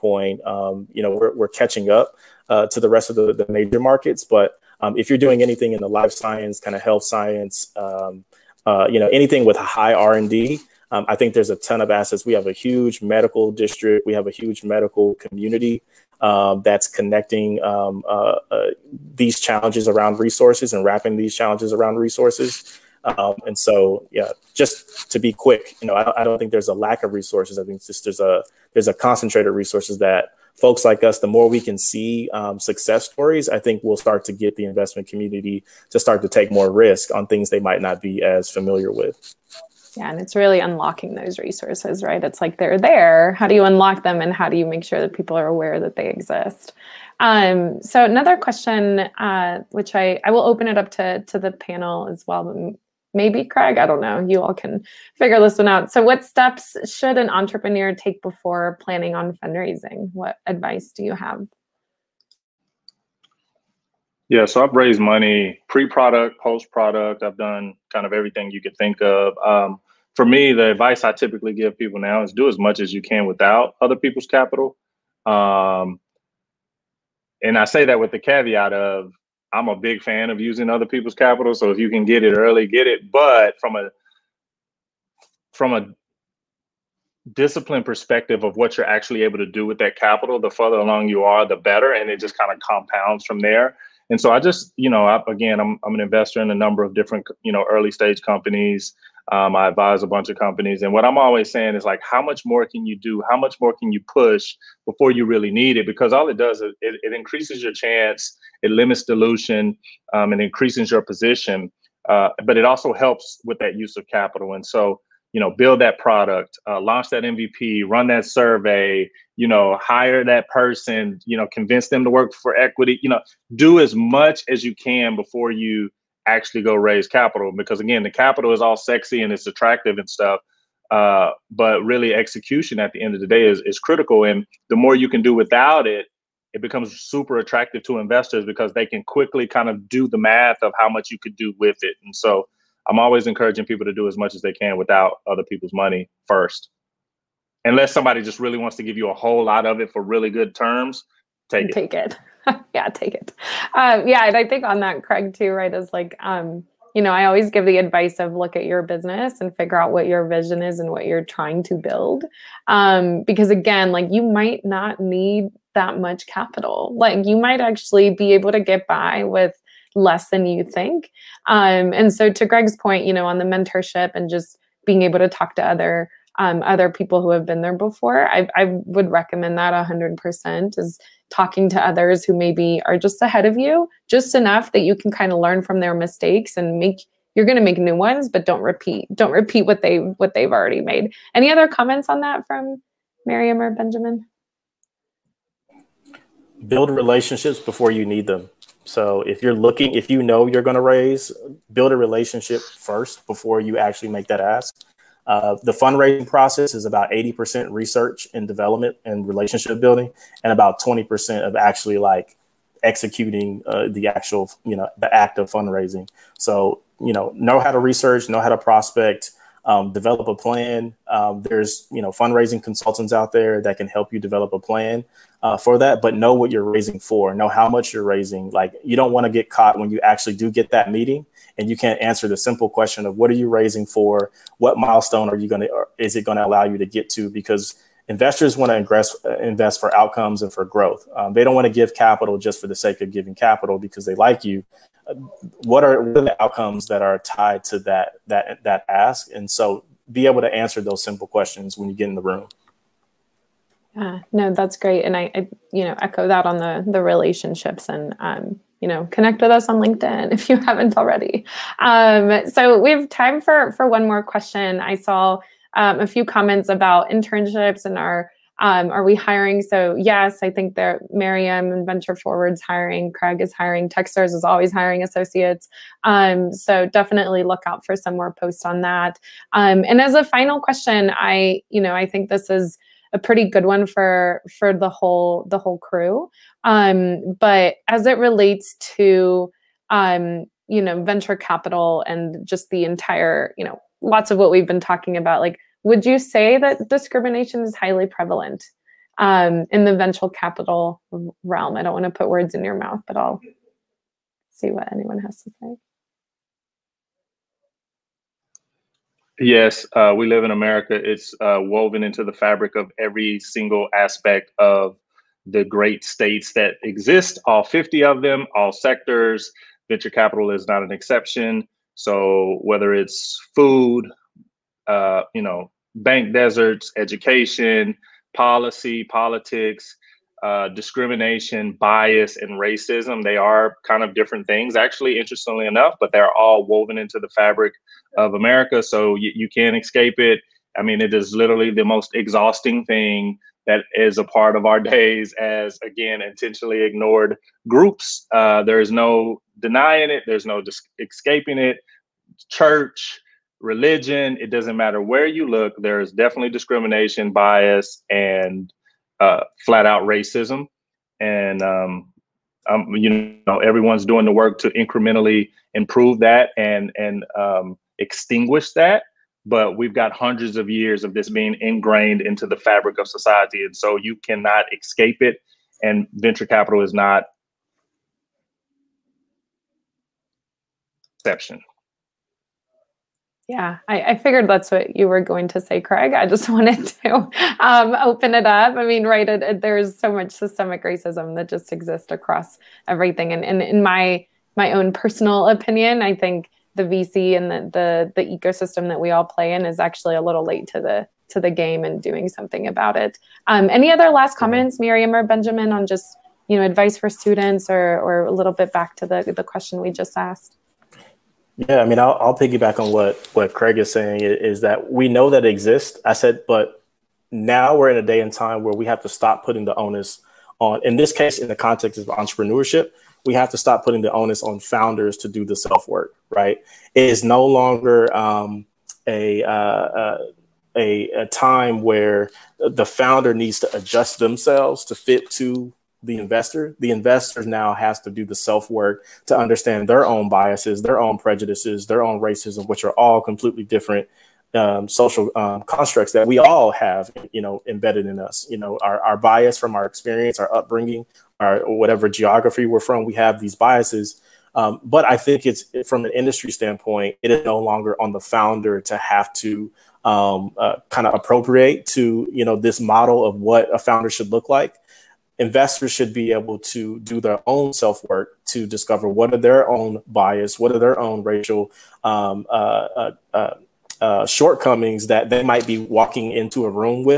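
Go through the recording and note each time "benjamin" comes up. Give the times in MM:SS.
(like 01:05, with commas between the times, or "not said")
03:13, 06:45.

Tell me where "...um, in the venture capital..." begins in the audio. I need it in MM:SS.
04:59.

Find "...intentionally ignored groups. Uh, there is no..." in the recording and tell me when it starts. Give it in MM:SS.
05:46.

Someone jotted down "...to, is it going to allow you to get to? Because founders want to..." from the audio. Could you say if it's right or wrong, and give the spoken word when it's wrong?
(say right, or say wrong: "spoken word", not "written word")
wrong: "investors", not "founders".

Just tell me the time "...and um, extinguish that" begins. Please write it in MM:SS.
06:06.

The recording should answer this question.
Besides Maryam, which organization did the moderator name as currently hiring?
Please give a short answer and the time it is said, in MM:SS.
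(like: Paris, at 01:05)
Venture Forward, at 04:31.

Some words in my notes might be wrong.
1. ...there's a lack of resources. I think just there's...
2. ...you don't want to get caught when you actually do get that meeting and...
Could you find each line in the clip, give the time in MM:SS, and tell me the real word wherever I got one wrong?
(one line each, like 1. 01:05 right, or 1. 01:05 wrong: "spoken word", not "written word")
1. 00:26 right
2. 03:48 right.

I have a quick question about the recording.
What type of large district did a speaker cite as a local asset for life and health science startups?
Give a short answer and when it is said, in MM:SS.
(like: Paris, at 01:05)
medical district, at 00:13.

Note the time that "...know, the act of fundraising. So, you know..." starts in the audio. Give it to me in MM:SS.
03:34.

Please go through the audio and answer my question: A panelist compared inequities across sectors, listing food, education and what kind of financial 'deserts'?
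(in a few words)
bank deserts.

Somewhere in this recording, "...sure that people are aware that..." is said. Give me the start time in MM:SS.
00:44.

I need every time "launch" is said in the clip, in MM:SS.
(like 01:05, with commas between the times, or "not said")
01:56.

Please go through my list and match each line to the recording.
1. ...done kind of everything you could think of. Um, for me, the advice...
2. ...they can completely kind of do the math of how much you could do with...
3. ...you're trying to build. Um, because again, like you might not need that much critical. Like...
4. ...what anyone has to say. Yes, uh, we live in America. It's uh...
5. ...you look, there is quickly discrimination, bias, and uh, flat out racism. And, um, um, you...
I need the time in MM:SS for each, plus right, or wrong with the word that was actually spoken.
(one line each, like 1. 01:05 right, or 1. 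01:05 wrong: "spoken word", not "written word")
1. 01:07 right
2. 02:18 wrong: "quickly", not "completely"
3. 02:41 wrong: "capital", not "critical"
4. 05:04 right
5. 05:55 wrong: "definitely", not "quickly".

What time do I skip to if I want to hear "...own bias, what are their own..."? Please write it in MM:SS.
07:49.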